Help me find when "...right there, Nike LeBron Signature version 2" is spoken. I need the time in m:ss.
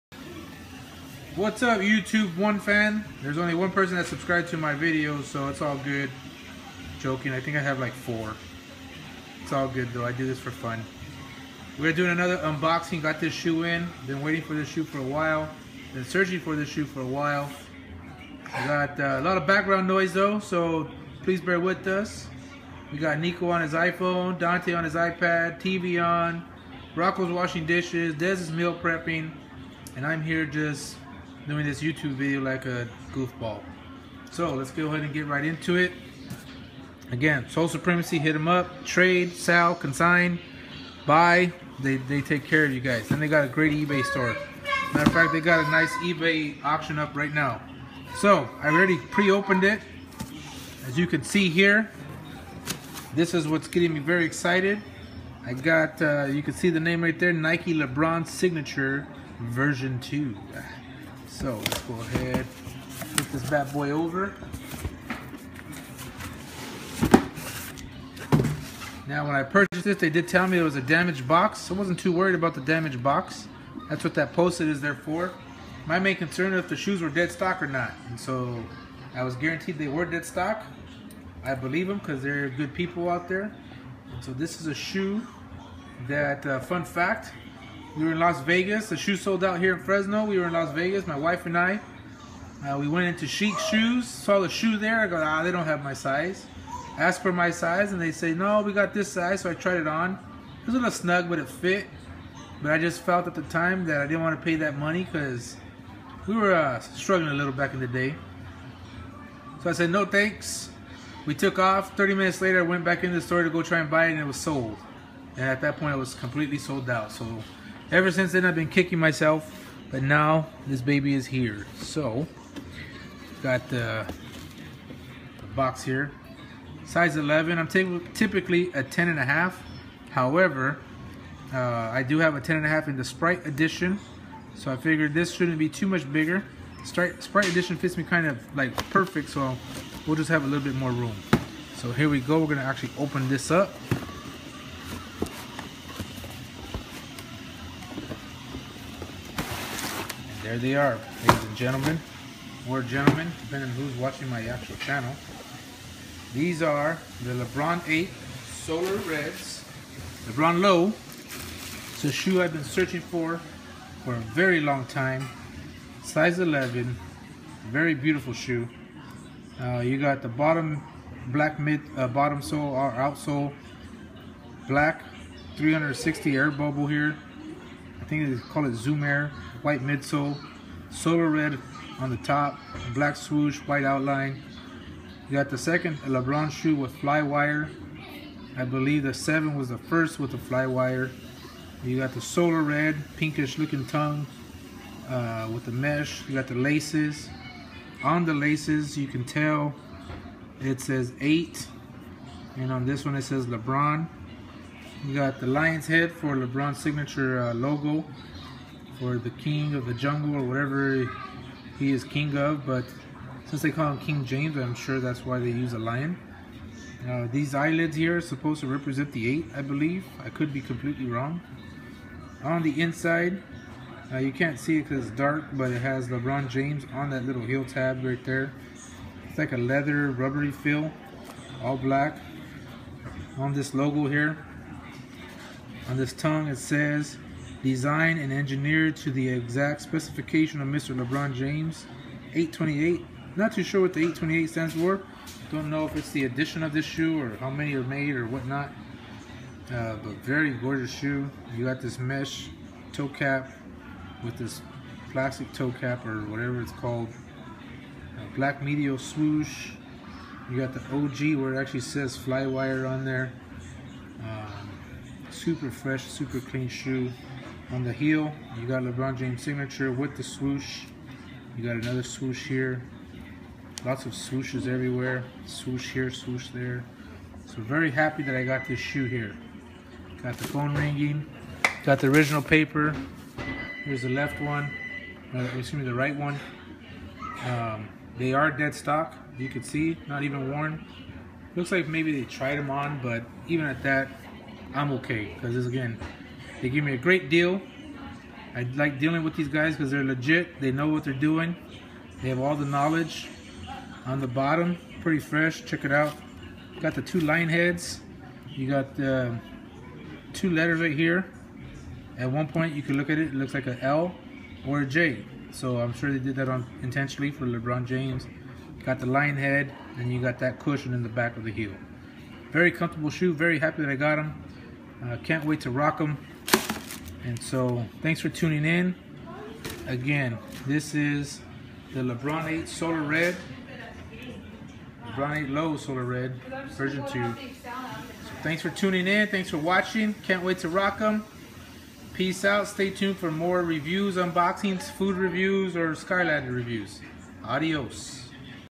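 0:57.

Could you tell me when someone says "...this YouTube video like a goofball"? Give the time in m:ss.
0:31.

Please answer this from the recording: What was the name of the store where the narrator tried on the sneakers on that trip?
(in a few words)
Chic Shoes.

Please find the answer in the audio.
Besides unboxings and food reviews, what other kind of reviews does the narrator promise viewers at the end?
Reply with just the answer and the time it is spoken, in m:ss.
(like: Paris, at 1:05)
Skylander reviews, at 5:45.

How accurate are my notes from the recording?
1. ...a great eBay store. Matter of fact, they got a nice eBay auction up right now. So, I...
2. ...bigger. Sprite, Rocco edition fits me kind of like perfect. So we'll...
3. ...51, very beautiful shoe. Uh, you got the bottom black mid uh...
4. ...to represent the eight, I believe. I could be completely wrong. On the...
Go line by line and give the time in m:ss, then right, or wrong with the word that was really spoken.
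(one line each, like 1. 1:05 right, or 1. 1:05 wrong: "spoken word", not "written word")
1. 0:43 right
2. 2:16 wrong: "Sprite", not "Rocco"
3. 2:46 wrong: "11", not "51"
4. 3:38 right.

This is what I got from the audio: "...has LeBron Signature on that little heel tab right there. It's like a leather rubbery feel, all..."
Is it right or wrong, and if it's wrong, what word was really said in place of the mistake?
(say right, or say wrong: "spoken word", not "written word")
wrong: "James", not "Signature".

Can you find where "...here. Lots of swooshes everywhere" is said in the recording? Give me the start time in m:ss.
4:32.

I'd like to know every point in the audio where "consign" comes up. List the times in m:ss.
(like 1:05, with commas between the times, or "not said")
0:39.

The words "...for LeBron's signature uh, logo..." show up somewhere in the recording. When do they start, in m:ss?
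3:26.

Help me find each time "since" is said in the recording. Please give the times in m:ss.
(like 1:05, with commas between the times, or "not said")
1:58, 3:33.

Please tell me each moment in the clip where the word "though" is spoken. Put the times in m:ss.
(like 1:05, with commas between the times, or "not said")
0:09, 0:20.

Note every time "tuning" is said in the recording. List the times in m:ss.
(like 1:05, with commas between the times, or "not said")
5:28, 5:38.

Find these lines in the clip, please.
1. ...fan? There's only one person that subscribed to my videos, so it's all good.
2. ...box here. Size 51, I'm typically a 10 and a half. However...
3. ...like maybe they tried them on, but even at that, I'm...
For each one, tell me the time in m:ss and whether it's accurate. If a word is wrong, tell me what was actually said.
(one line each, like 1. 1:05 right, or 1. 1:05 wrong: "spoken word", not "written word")
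1. 0:02 right
2. 2:05 wrong: "11", not "51"
3. 4:51 right.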